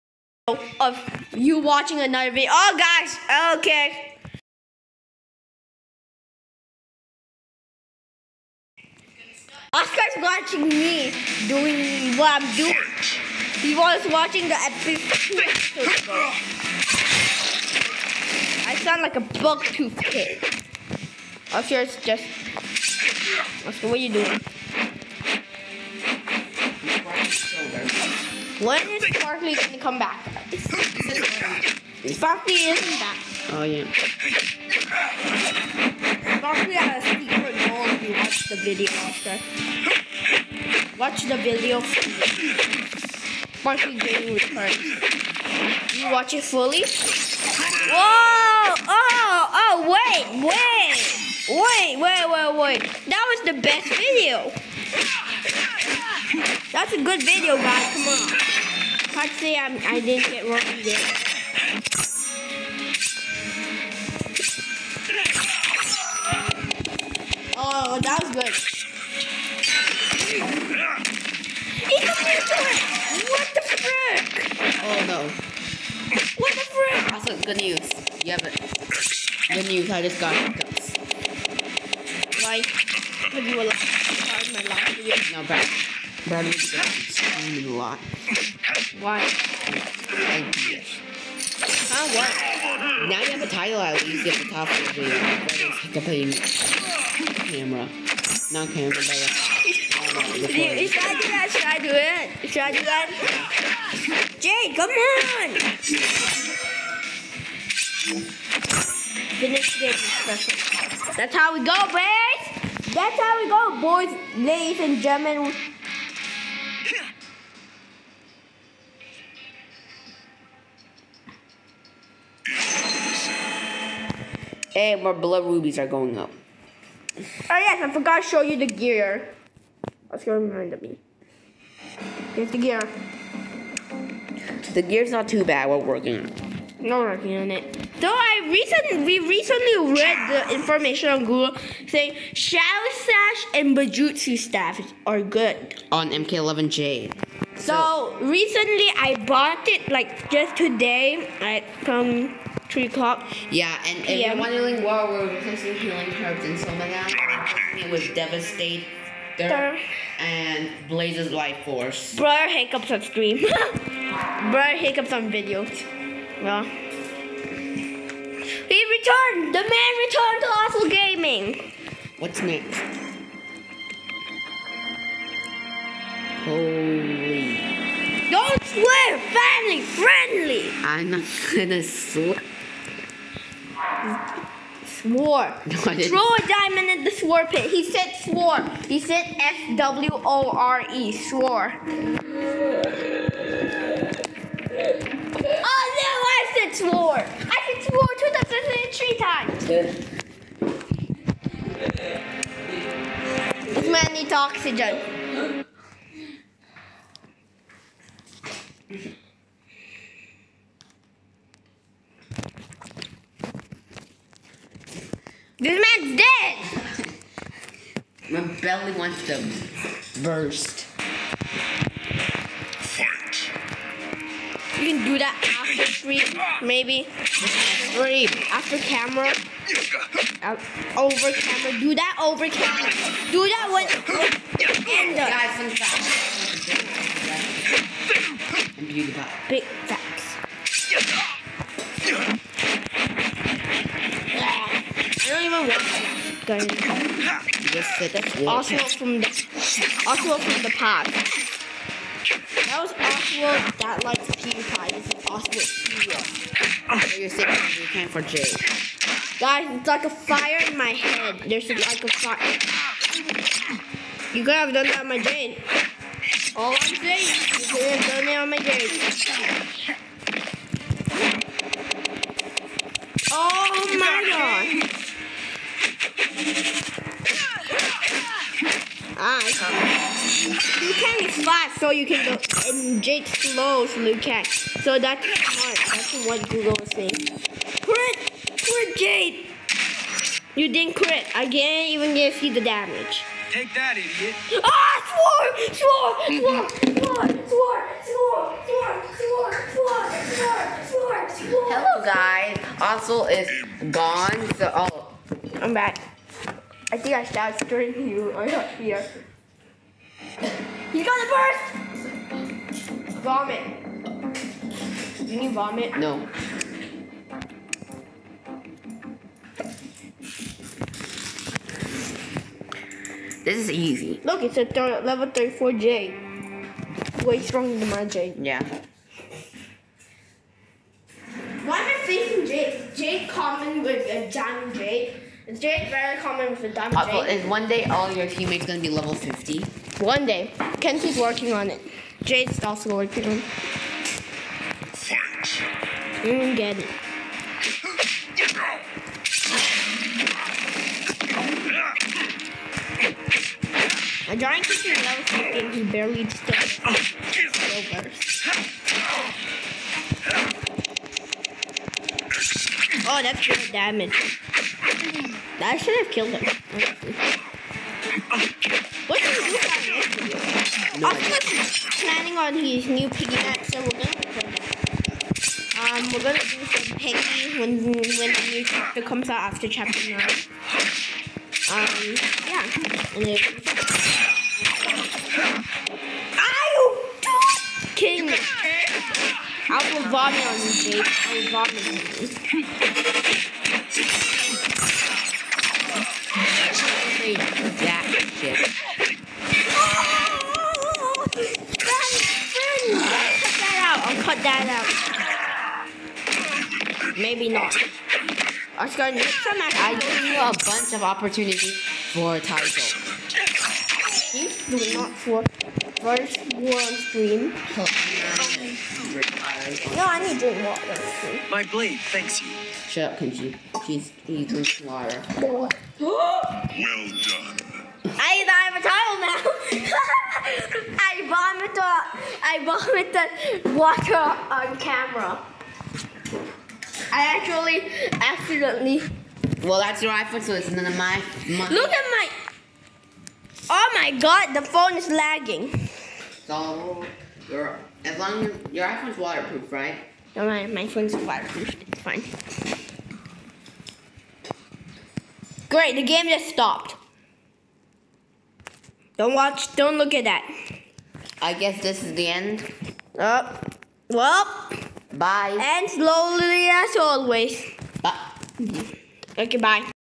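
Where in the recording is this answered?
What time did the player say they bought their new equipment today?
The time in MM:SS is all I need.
02:32.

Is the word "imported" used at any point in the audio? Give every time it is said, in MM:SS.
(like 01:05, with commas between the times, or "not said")
not said.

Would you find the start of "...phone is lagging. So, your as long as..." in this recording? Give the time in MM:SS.
07:24.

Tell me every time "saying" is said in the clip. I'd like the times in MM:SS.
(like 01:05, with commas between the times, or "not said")
02:21, 04:17, 04:26, 04:46.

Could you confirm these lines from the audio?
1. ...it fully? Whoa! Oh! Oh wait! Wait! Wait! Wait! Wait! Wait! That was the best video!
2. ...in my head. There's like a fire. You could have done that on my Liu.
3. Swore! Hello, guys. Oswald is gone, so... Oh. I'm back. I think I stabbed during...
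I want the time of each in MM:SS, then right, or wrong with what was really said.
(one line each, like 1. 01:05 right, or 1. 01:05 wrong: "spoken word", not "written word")
1. 00:46 right
2. 04:20 wrong: "Jane", not "Liu"
3. 05:01 right.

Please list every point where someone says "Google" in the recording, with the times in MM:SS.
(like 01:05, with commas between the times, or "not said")
02:21, 04:46.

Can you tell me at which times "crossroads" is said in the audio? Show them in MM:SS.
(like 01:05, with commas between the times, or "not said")
not said.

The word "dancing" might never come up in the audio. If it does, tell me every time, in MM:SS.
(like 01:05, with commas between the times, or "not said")
not said.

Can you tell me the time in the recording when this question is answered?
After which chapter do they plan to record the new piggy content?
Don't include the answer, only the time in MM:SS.
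06:19.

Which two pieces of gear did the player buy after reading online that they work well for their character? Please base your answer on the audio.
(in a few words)
Shadow Sash and Bojutsu staff.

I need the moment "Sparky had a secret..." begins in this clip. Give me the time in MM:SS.
00:36.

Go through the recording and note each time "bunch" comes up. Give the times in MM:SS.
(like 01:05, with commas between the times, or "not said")
06:50.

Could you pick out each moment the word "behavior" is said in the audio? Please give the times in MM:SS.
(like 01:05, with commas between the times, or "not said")
not said.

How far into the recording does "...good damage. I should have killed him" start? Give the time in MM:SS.
06:03.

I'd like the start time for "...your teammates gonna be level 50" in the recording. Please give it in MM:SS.
05:38.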